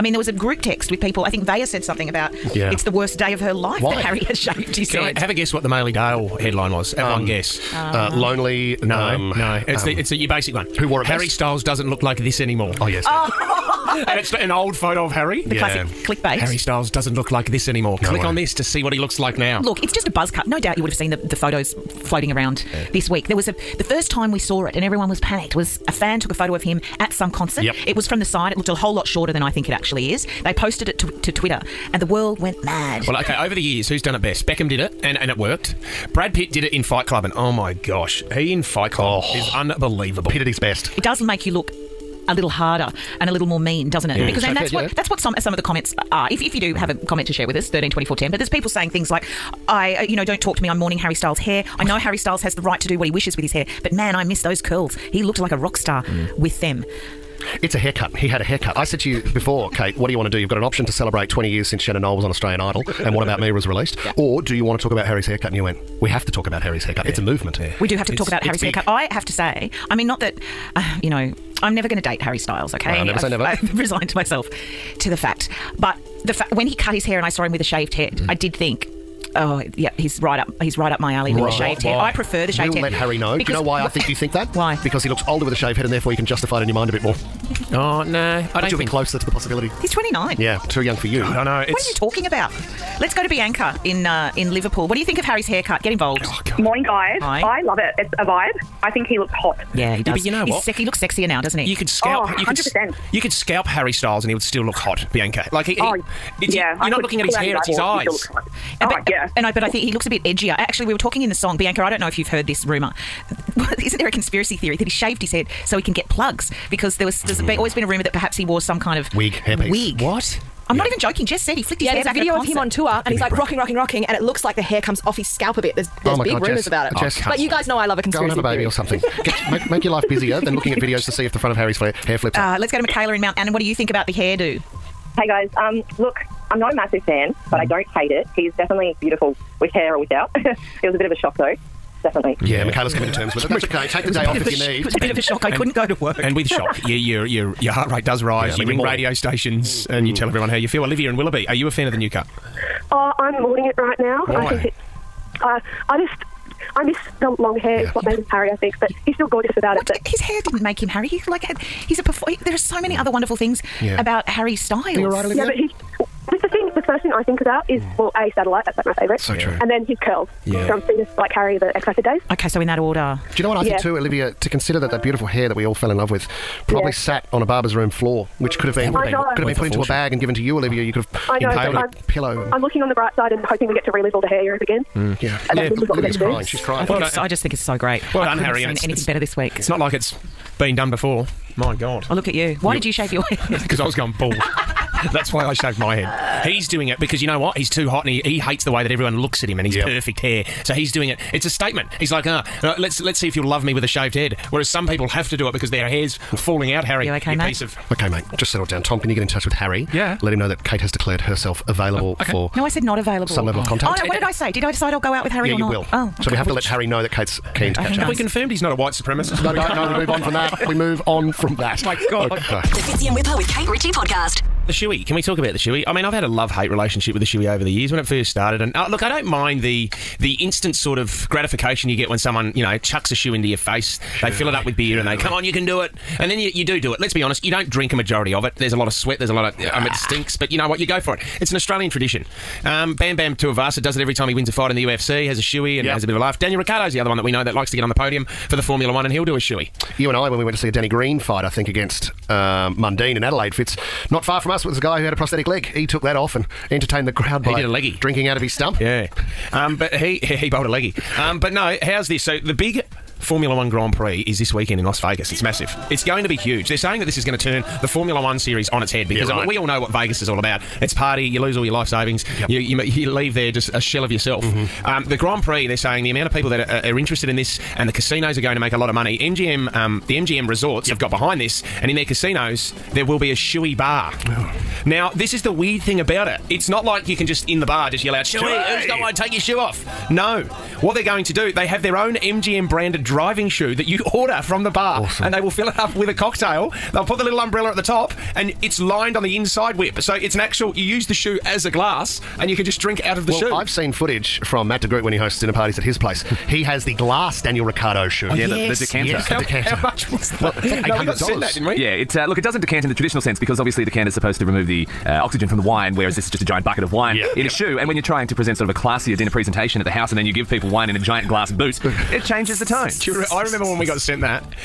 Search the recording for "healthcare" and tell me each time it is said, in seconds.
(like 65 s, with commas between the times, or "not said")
not said.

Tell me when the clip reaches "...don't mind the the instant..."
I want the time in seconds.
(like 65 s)
229 s.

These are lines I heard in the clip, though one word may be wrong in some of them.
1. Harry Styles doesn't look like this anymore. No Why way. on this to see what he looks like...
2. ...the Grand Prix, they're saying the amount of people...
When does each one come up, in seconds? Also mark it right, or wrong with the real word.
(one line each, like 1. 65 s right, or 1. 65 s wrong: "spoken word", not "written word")
1. 16 s wrong: "Click", not "Why"
2. 275 s right.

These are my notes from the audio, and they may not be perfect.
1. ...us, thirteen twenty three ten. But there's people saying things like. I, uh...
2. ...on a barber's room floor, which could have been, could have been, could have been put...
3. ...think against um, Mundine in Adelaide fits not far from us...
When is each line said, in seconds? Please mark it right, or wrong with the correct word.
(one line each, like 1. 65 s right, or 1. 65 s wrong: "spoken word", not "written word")
1. 47 s wrong: "four", not "three"
2. 177 s right
3. 251 s right.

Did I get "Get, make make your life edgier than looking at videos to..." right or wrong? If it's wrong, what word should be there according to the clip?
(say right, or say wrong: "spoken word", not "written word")
wrong: "busier", not "edgier".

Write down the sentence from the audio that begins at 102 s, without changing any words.
Oh, percent You could scalp Harry Styles, and he would still look hot, Bianca.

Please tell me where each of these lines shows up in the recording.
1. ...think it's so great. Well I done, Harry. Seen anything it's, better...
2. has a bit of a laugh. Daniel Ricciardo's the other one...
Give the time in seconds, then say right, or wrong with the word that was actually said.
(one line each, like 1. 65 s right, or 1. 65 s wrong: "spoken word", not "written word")
1. 187 s right
2. 245 s right.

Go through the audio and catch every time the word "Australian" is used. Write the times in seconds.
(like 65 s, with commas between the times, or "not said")
62 s, 241 s.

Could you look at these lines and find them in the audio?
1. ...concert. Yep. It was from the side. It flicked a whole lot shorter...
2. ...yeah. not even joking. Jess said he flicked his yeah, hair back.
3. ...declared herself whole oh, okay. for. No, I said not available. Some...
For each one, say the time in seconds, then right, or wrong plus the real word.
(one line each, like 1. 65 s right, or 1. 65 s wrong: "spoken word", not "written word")
1. 27 s wrong: "looked", not "flicked"
2. 120 s right
3. 210 s wrong: "available", not "whole".